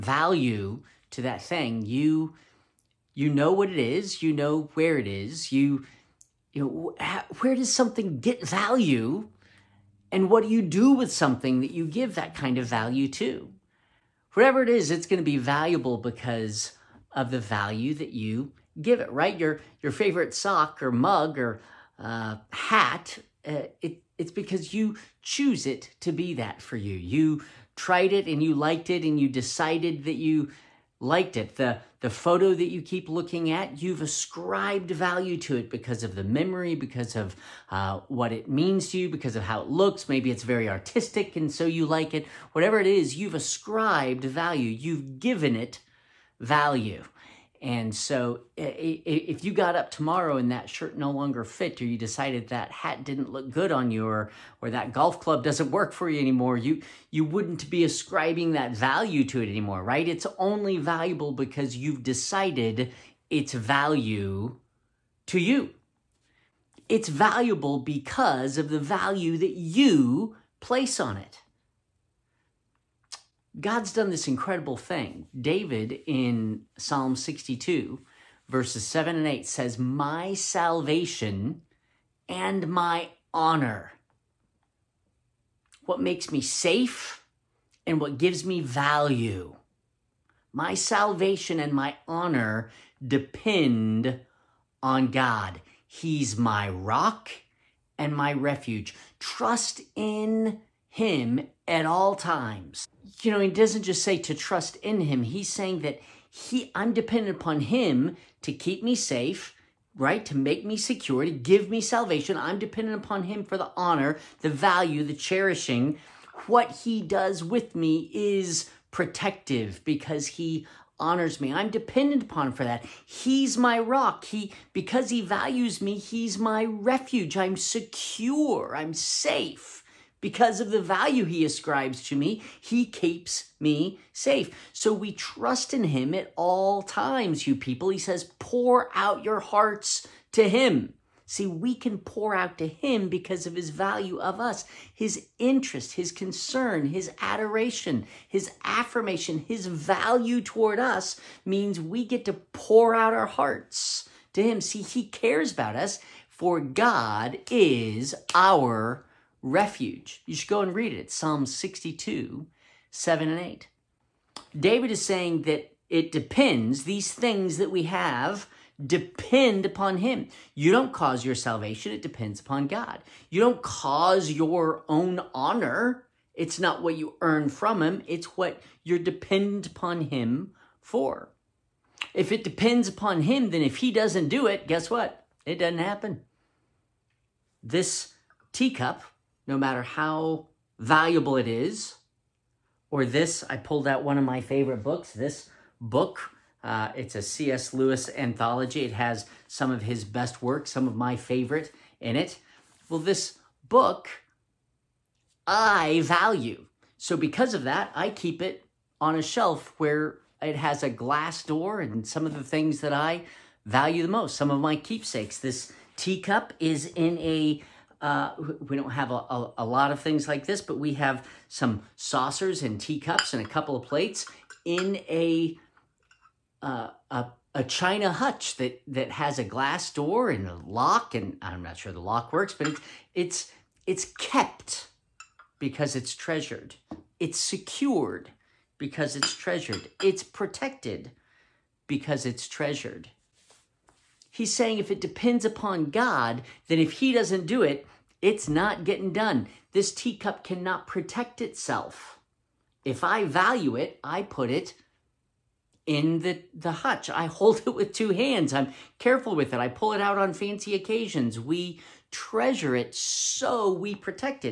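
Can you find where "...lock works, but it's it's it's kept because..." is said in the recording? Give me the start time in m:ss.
3:51.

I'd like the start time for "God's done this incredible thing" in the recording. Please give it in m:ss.
1:13.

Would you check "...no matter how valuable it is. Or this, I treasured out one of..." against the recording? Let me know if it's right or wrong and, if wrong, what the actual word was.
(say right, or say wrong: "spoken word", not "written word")
wrong: "pulled", not "treasured".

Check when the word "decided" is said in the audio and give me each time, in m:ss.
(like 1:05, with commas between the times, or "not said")
0:29, 0:51, 1:02.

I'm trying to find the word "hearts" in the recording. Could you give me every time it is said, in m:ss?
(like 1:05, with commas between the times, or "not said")
2:19, 2:33.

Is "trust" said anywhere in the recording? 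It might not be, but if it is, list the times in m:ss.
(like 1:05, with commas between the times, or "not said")
1:39, 1:44, 2:15.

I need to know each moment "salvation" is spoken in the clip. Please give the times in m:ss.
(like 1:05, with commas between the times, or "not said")
1:20, 1:30, 1:51, 2:51.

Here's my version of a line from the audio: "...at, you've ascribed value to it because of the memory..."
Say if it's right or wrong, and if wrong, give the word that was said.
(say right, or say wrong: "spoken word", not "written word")
right.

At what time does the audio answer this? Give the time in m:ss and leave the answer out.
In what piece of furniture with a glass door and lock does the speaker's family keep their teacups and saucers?
3:47.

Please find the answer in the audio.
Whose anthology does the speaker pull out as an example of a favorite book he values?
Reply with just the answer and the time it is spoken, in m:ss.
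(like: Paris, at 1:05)
C.S. Lewis, at 3:17.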